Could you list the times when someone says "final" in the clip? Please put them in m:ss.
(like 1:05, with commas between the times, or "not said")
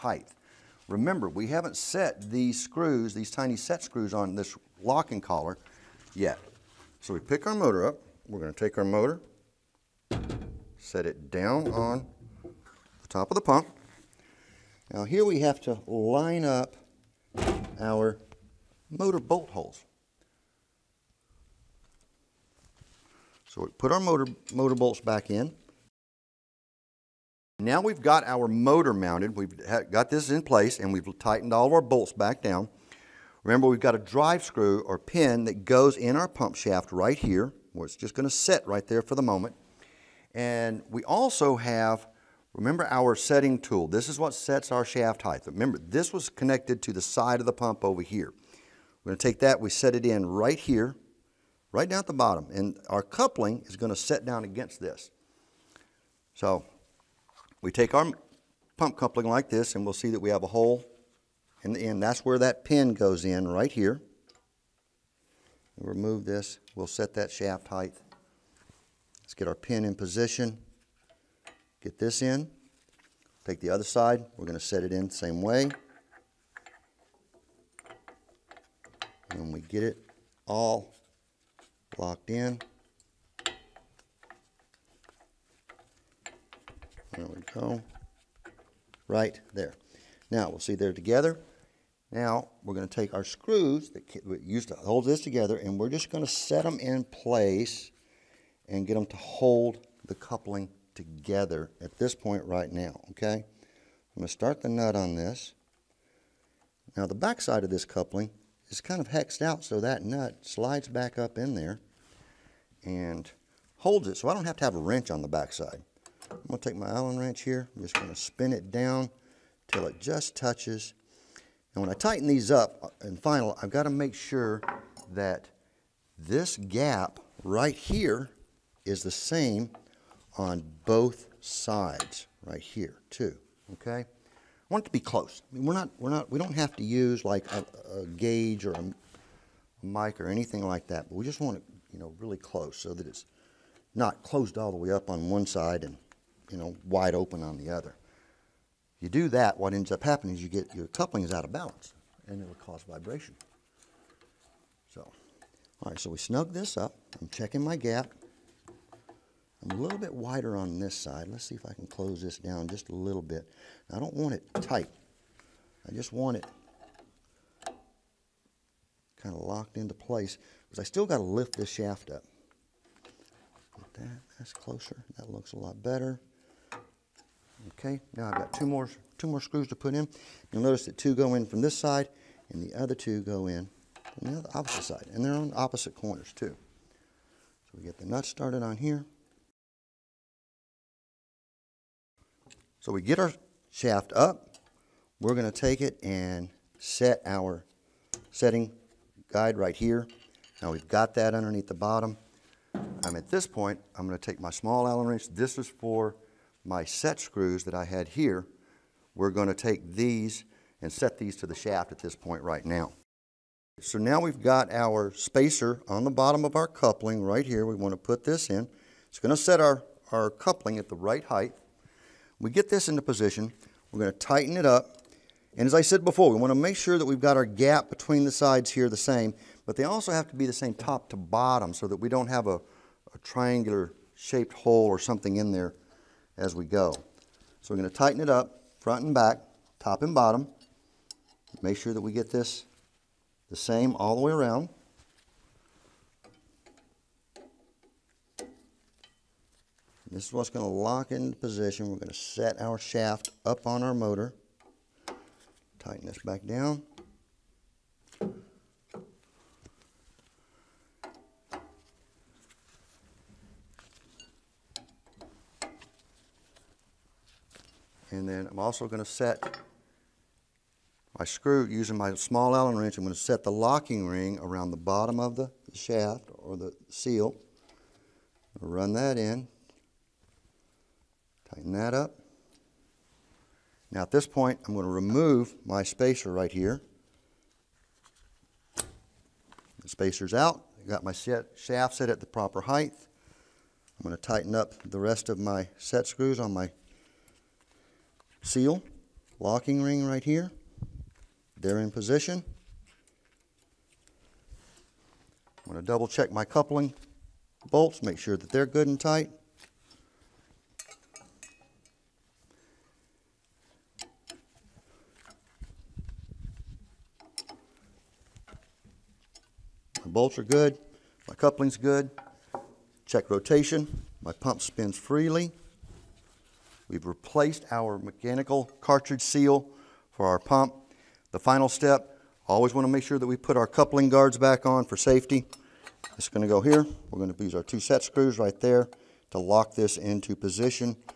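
2:03, 5:31.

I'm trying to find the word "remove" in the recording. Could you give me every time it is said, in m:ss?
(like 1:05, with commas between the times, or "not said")
1:05, 4:44.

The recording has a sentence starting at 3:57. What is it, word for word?
So we're going to tighten it up front and back, top and bottom.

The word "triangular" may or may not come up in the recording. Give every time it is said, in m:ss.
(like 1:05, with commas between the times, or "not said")
3:53.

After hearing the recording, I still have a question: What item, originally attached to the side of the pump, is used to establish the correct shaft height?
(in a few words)
Setting tool.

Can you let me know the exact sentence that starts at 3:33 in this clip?
So now we've got our spacer on the bottom of our coupling right here.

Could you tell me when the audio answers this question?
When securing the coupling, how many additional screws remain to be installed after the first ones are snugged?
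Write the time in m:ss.
2:59.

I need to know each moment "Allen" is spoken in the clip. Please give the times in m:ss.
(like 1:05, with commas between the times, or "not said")
1:56, 3:24, 4:32.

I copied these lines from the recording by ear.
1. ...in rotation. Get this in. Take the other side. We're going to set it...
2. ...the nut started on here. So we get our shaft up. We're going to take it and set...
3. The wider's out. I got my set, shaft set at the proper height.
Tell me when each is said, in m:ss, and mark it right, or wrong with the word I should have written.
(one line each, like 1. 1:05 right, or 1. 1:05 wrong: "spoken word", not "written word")
1. 1:09 wrong: "position", not "rotation"
2. 3:07 right
3. 4:48 wrong: "spacer", not "wider".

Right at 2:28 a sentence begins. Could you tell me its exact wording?
You do that, what ends up happening is you get your coupling is out of balance and it'll cause vibration.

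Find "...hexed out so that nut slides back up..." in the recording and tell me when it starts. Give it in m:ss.
1:49.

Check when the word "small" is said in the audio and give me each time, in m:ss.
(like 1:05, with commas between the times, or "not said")
3:24, 4:32.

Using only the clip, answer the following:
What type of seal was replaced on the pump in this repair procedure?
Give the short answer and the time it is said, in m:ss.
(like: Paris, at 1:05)
Mechanical cartridge seal, at 5:27.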